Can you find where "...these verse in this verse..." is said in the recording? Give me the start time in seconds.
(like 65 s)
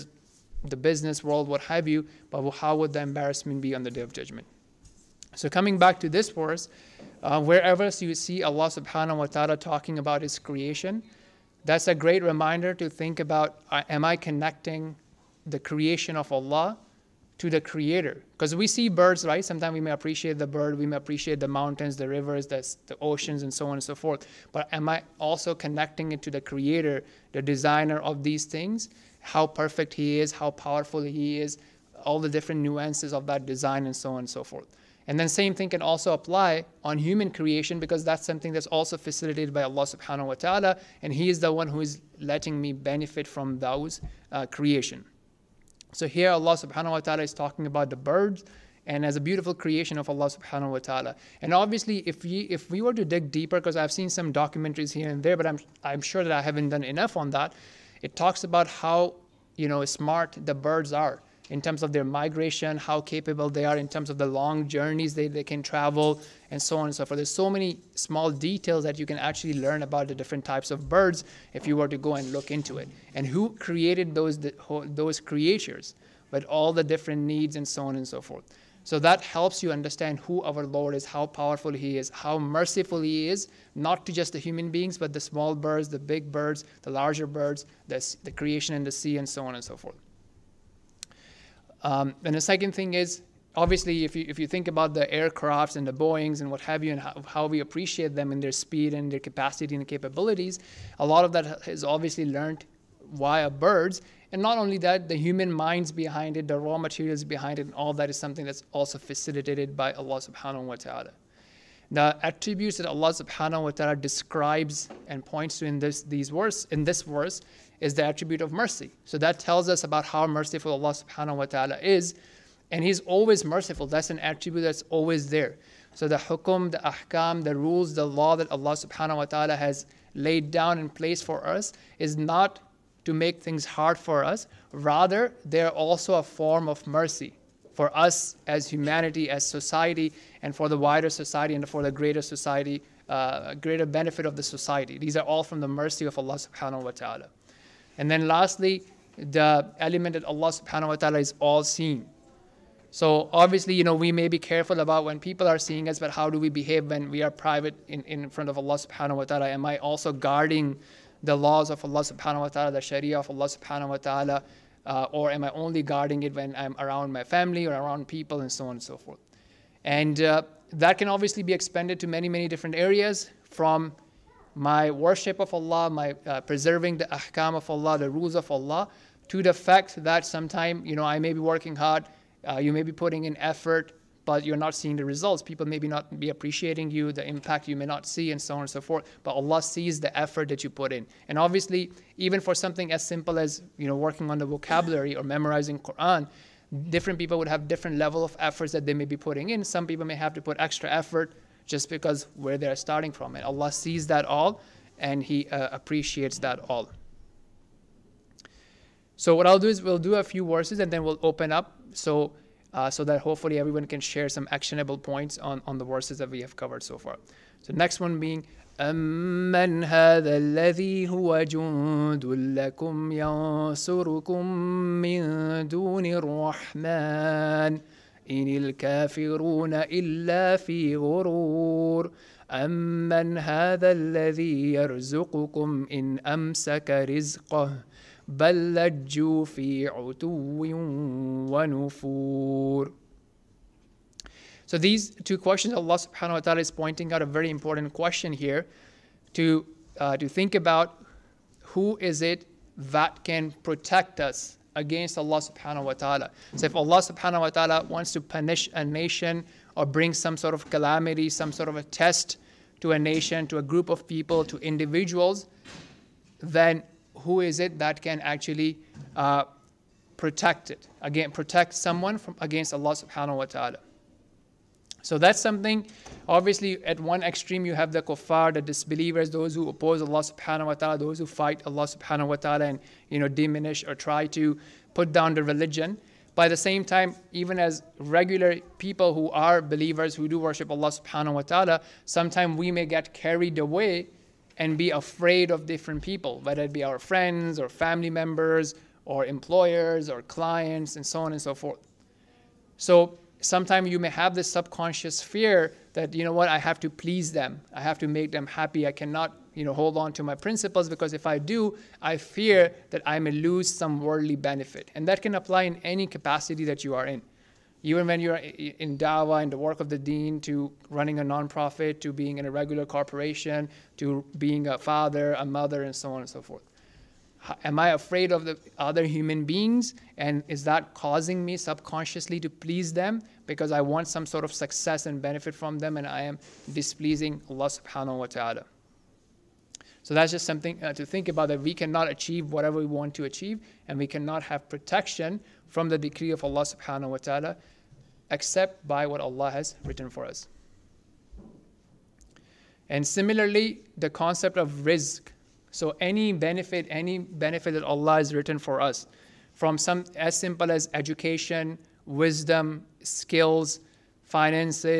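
116 s.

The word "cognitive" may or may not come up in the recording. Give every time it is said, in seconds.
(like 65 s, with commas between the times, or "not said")
not said.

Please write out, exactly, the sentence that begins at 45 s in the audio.
So here Allah subhanahu wa ta'ala is talking about the birds and as a beautiful creation of Allah subhanahu wa ta'ala.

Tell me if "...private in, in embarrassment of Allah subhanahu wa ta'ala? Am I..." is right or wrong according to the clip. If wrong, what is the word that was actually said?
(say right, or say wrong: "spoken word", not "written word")
wrong: "front", not "embarrassment".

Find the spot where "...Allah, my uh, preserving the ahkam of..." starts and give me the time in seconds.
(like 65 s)
175 s.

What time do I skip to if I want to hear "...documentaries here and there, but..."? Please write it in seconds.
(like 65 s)
54 s.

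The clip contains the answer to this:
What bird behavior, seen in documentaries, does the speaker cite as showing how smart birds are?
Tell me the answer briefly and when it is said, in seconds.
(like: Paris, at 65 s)
Migration, at 62 s.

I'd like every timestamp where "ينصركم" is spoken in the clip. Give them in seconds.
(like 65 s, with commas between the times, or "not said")
223 s.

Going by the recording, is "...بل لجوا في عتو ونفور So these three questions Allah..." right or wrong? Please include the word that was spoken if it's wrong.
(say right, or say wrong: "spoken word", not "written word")
wrong: "two", not "three".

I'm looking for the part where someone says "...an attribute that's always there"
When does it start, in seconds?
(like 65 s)
124 s.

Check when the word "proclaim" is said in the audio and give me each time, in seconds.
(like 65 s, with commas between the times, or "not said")
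not said.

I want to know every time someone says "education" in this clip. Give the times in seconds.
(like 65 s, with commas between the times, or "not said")
360 s.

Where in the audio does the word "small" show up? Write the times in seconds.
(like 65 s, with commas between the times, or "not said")
67 s, 85 s.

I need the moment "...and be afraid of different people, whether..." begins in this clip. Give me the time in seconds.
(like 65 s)
294 s.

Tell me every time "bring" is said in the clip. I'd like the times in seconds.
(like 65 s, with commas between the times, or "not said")
259 s.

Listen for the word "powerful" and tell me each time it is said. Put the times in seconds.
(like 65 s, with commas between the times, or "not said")
30 s, 81 s.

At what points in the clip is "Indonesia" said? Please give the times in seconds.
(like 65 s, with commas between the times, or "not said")
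not said.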